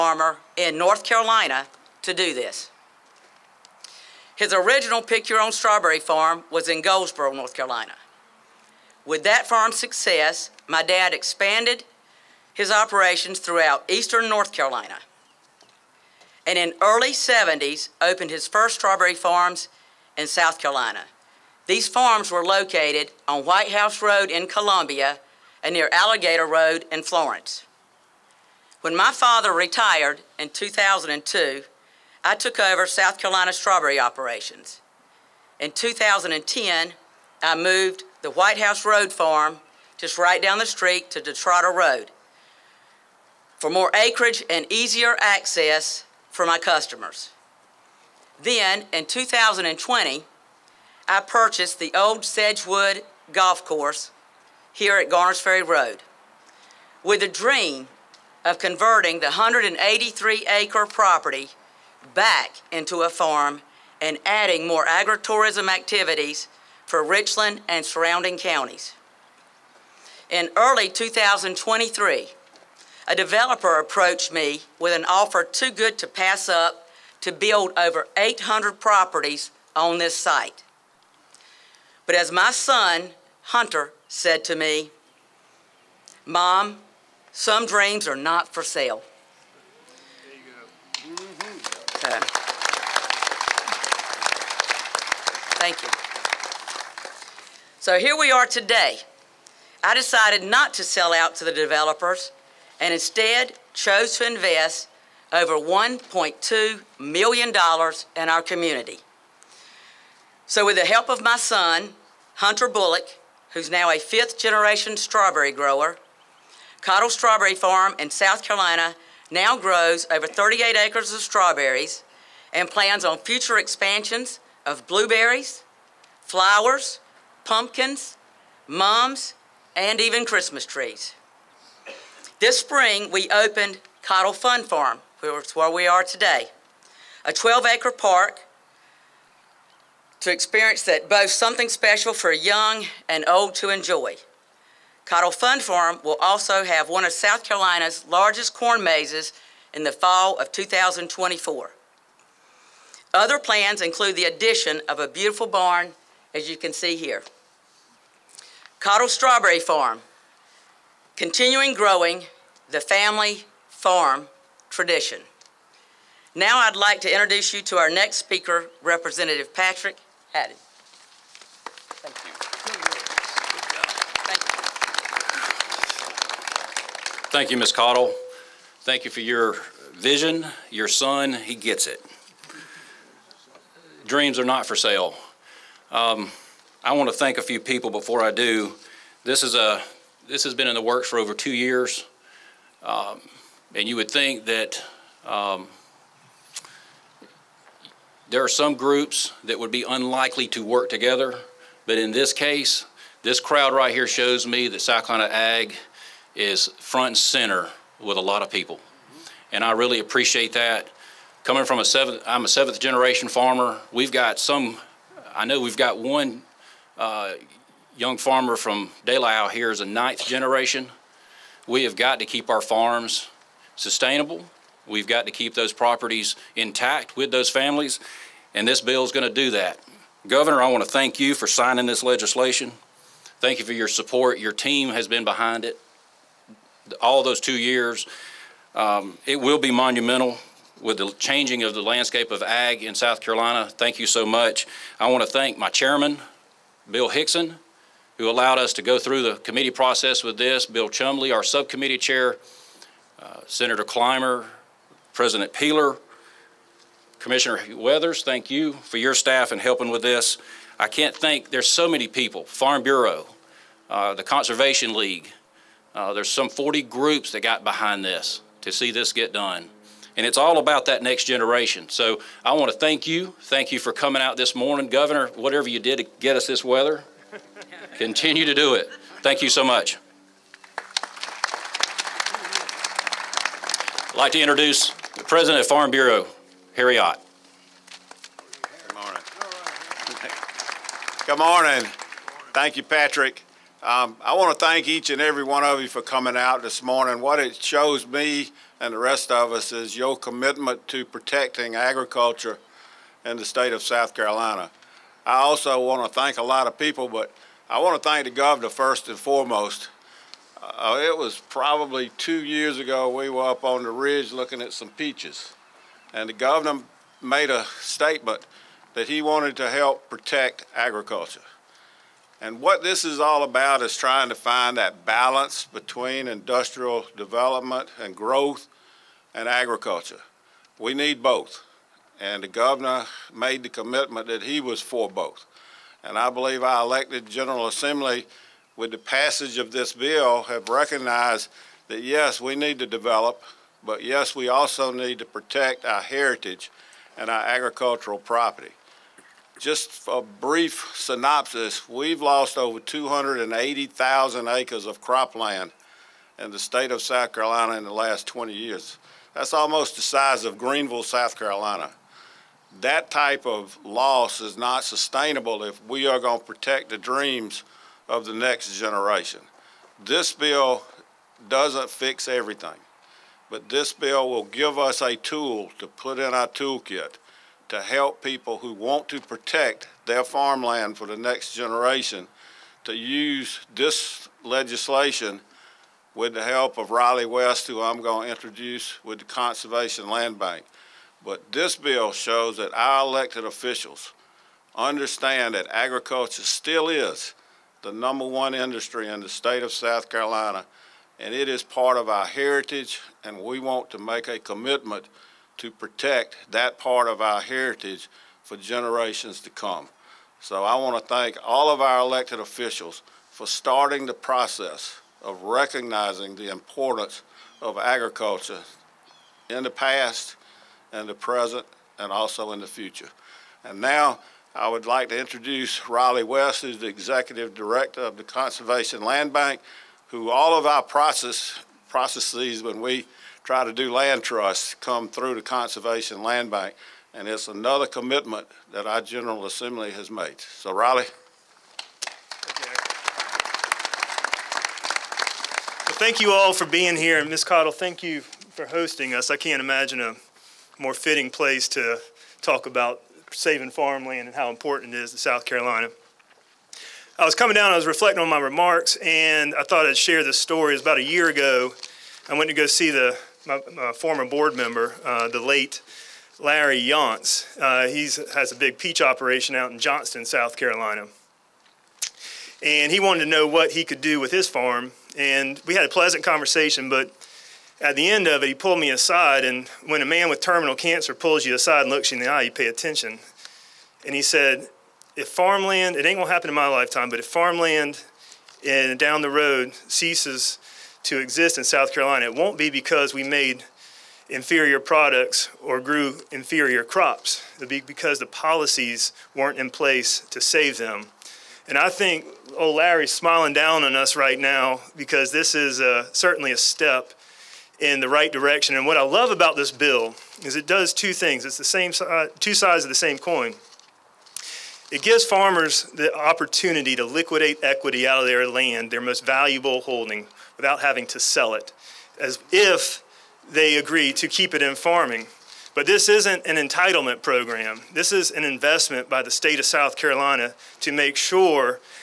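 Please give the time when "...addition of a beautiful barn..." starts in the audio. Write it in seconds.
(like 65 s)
154 s.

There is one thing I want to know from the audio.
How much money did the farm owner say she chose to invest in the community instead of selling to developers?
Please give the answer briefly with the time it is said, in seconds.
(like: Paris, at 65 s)
$1.2 million, at 105 s.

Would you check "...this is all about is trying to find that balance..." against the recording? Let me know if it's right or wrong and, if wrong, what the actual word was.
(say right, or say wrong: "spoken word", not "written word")
right.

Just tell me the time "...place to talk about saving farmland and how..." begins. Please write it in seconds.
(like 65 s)
451 s.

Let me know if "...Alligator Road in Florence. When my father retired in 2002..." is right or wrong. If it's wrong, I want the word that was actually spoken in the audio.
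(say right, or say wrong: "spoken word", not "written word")
right.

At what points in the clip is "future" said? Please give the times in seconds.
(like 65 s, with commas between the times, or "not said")
123 s, 422 s.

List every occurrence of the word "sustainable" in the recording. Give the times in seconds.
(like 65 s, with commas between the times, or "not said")
223 s, 364 s.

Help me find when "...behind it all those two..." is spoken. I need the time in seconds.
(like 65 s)
235 s.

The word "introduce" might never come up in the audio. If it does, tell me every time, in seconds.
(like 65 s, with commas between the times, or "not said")
167 s, 284 s, 388 s, 425 s.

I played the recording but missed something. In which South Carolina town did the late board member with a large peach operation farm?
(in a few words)
Johnston.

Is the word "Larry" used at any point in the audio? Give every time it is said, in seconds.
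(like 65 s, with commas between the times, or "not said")
466 s, 502 s.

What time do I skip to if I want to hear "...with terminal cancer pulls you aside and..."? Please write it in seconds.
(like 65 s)
480 s.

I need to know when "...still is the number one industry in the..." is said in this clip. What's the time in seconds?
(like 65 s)
396 s.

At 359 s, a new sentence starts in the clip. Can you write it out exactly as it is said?
That's almost the size of Greenville, South Carolina.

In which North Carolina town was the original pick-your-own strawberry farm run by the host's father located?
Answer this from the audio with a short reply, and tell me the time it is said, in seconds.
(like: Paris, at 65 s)
Goldsboro, at 6 s.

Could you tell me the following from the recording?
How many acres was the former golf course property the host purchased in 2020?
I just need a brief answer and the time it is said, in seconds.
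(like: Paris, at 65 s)
183, at 59 s.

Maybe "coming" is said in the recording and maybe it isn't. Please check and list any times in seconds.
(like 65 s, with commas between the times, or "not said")
211 s, 273 s, 296 s, 457 s.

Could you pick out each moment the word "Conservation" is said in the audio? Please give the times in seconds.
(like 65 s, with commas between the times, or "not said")
264 s, 389 s, 428 s, 435 s.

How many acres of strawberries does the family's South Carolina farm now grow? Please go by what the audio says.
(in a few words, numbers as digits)
38.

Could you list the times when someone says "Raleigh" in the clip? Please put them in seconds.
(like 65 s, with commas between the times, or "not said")
386 s, 425 s, 440 s.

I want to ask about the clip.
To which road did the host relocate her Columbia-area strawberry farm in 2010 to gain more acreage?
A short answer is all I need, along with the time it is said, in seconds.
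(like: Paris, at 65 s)
Detroit Road, at 41 s.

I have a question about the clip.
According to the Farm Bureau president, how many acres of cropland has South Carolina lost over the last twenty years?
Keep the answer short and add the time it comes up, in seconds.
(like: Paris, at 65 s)
280,000, at 352 s.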